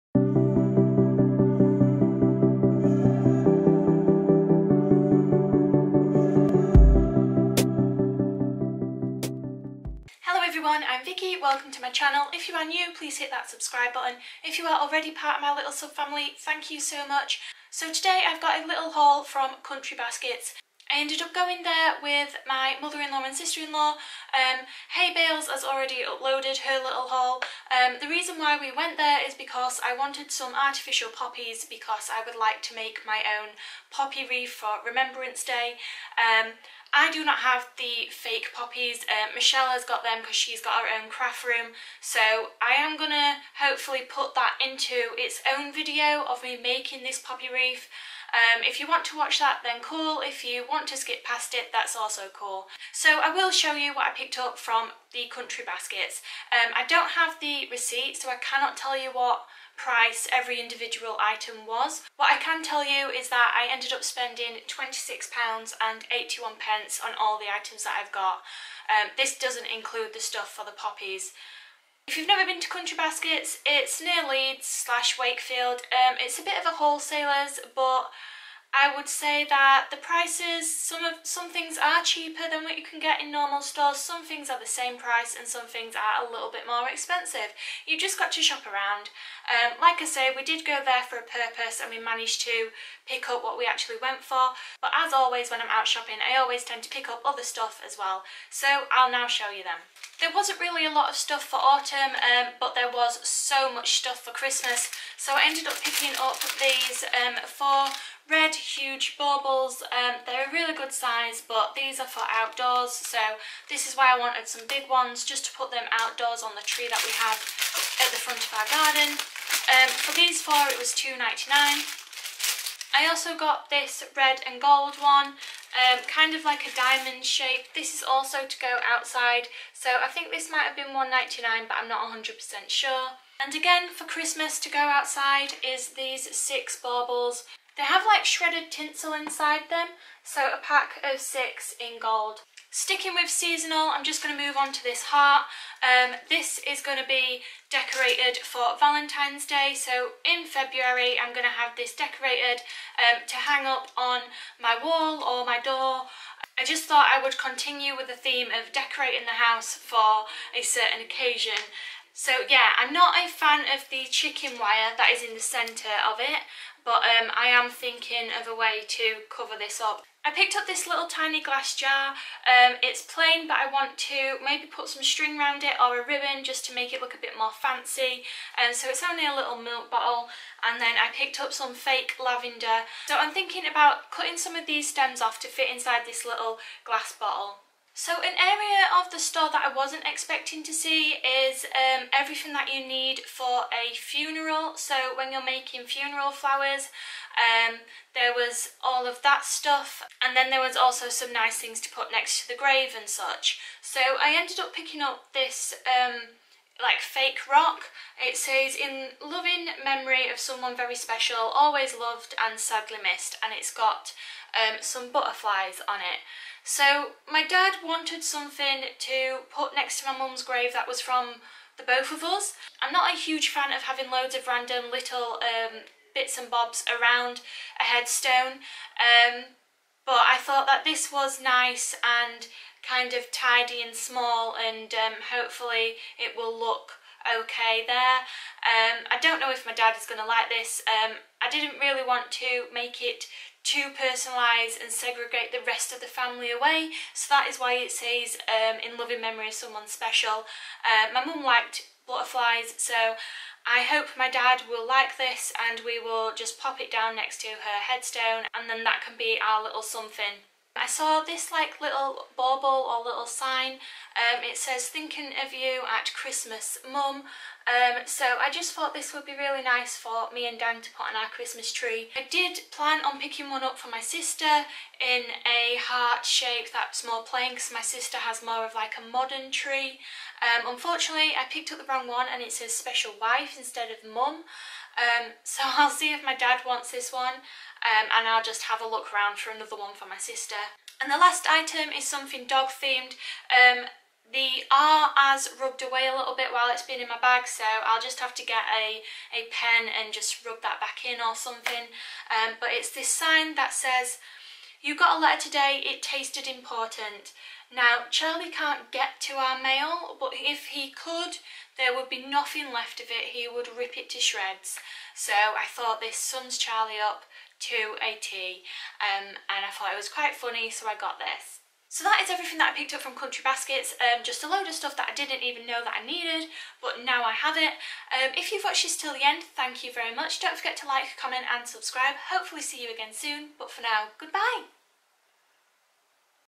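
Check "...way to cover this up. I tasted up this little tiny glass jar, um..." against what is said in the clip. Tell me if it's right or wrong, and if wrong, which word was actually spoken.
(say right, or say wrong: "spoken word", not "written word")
wrong: "picked", not "tasted".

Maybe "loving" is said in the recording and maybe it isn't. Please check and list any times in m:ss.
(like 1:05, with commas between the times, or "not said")
3:29, 4:08.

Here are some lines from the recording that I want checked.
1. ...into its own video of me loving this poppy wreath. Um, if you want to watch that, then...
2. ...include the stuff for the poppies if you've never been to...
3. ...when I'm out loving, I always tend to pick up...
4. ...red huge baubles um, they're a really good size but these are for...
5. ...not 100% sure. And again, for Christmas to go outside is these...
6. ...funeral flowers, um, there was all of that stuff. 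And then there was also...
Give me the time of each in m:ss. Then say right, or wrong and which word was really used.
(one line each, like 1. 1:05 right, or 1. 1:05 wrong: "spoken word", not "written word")
1. 0:44 wrong: "making", not "loving"
2. 1:09 right
3. 1:35 wrong: "shopping", not "loving"
4. 1:48 right
5. 2:11 right
6. 3:15 right.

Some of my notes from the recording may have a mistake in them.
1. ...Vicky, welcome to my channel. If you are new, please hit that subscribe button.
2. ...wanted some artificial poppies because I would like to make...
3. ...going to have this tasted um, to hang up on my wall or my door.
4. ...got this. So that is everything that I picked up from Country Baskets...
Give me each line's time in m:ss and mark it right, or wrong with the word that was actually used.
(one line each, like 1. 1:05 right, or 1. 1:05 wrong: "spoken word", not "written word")
1. 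0:11 right
2. 0:29 right
3. 2:31 wrong: "decorated", not "tasted"
4. 5:20 right.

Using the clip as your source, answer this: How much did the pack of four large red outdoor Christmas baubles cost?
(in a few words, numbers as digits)
2.99.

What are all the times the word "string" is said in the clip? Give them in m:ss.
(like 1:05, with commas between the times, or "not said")
2:55.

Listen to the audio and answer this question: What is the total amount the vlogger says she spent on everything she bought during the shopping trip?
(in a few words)
£26.81.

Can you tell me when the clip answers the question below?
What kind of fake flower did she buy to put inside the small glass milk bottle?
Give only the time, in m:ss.
3:02.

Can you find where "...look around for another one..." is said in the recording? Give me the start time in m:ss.
4:48.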